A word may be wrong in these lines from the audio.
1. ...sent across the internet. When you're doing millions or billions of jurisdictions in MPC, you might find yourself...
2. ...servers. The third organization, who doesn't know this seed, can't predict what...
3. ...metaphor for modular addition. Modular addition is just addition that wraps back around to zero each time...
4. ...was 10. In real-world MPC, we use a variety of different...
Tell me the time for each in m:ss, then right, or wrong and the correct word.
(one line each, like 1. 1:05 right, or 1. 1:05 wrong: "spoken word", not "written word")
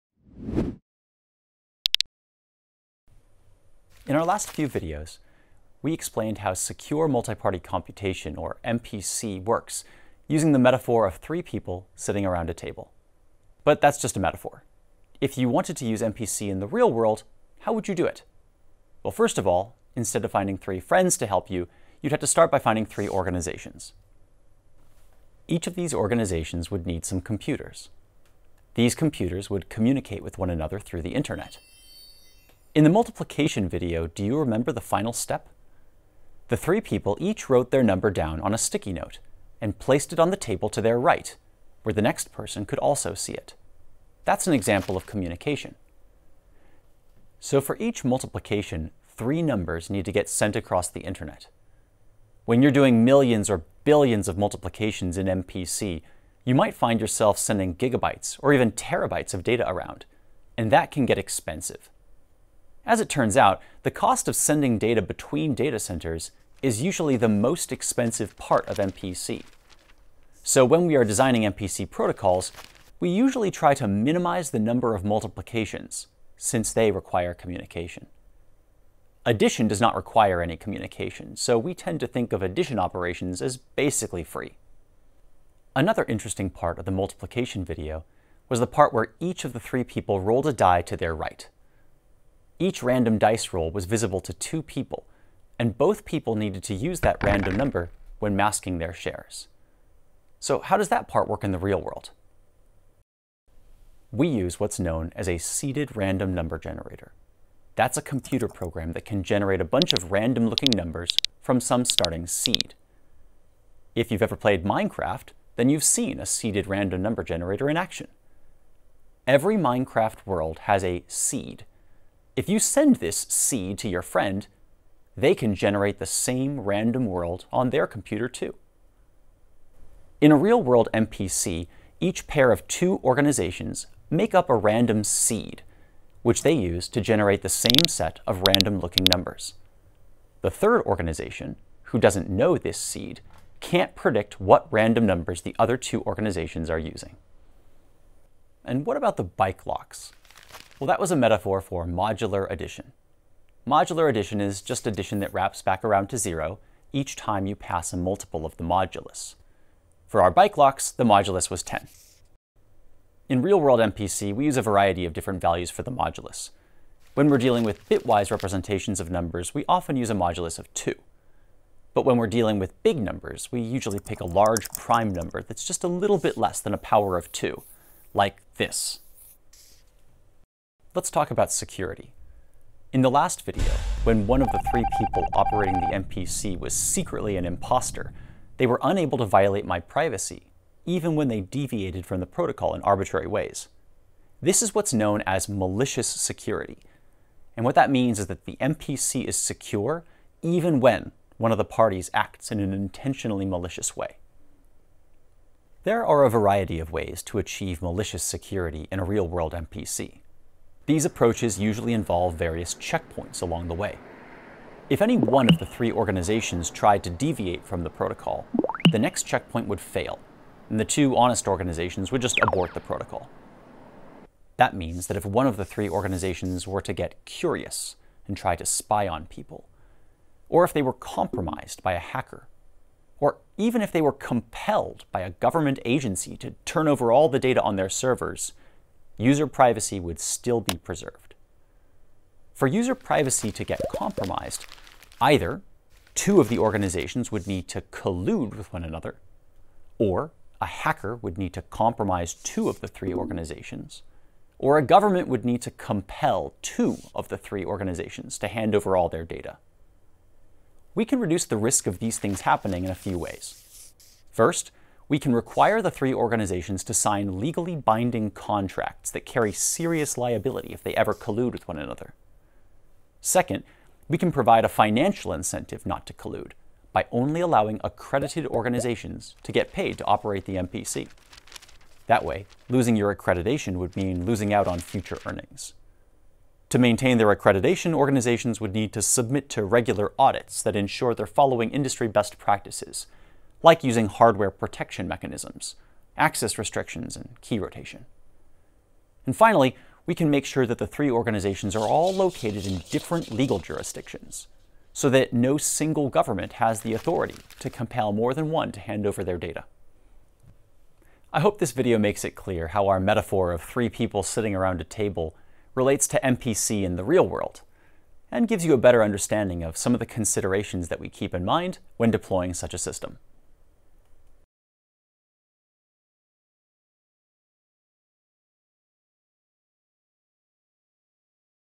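1. 0:50 wrong: "multiplications", not "jurisdictions"
2. 2:19 wrong: "numbers", not "servers"
3. 2:31 right
4. 2:41 right.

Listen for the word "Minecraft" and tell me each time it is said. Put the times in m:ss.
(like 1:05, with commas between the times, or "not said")
1:54, 1:59.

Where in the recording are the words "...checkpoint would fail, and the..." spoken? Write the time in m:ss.
3:39.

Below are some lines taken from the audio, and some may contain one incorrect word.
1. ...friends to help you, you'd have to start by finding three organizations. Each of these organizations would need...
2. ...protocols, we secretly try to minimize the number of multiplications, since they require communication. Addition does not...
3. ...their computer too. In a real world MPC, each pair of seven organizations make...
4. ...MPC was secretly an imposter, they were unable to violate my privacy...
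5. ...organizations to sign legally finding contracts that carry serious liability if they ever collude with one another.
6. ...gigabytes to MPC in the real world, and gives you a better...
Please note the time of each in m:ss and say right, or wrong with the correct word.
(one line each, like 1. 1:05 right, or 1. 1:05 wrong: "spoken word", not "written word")
1. 0:20 right
2. 1:11 wrong: "usually", not "secretly"
3. 2:07 wrong: "two", not "seven"
4. 3:06 right
5. 4:26 wrong: "binding", not "finding"
6. 5:15 wrong: "relates", not "gigabytes".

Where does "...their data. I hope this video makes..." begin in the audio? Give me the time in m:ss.
5:09.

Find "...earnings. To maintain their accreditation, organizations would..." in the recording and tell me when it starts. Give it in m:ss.
4:45.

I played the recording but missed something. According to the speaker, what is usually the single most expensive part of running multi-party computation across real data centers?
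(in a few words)
sending data between data centers.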